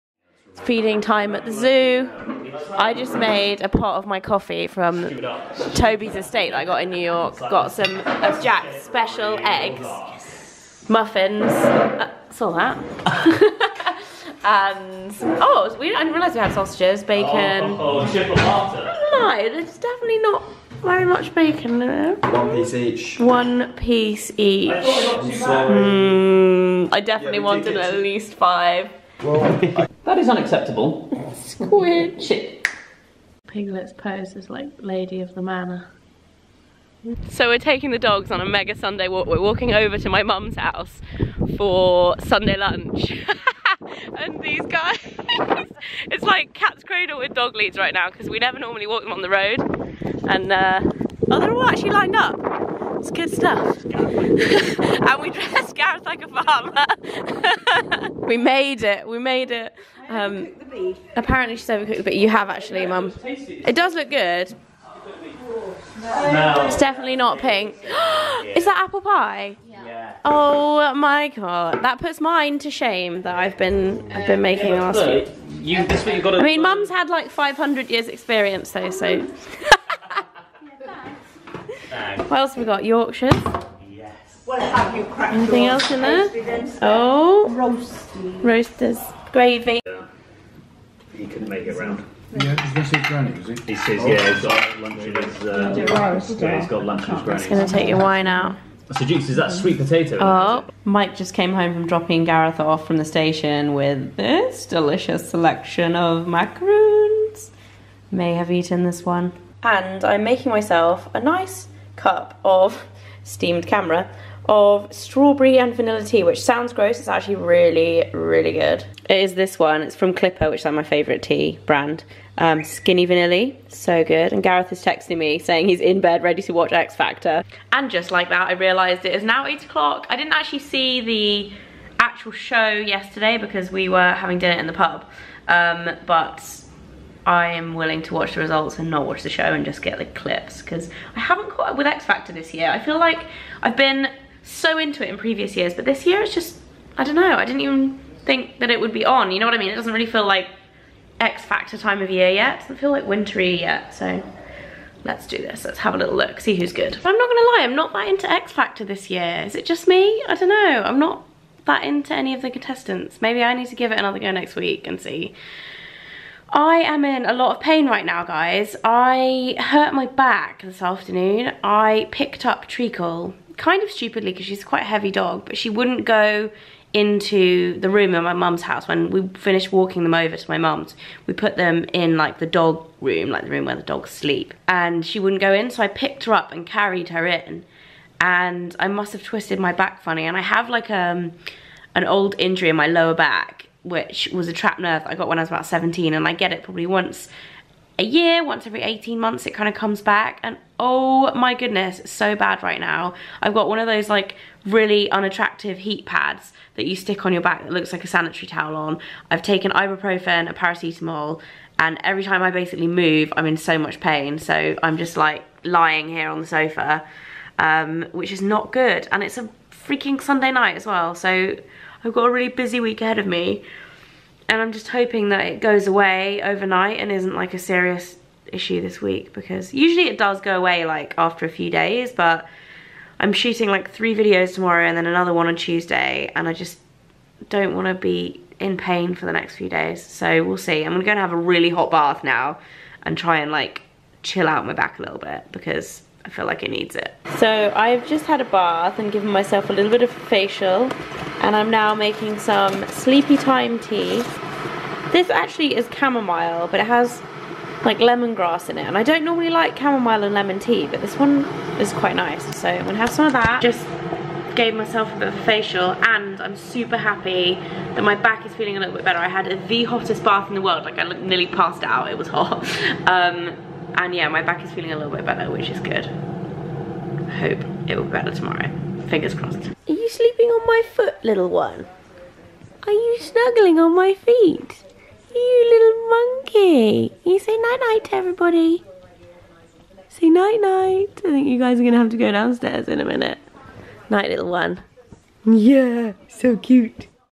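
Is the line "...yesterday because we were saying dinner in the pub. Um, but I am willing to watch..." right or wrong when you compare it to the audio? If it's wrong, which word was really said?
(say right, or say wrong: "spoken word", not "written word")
wrong: "having", not "saying".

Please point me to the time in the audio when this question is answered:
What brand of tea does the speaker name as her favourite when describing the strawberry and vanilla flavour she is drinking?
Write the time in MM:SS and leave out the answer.
02:00.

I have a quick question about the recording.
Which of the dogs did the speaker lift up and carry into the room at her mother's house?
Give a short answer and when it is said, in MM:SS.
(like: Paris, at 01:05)
Treacle, at 02:52.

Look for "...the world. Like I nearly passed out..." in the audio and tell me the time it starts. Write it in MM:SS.
04:30.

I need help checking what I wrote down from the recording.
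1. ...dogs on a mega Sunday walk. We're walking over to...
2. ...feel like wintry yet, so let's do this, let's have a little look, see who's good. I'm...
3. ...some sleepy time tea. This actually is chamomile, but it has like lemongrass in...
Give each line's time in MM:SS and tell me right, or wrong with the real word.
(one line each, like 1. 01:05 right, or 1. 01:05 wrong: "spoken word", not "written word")
1. 00:37 right
2. 02:32 right
3. 04:12 right.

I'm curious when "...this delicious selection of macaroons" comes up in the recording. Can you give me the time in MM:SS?
01:44.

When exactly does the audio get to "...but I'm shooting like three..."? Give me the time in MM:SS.
03:52.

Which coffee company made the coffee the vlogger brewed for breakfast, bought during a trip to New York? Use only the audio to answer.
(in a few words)
Toby's Estate.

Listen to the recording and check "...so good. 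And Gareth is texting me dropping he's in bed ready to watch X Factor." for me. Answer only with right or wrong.
wrong.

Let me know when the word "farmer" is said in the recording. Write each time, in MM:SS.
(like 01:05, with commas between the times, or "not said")
00:56.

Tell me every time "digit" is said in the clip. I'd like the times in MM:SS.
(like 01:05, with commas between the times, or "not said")
not said.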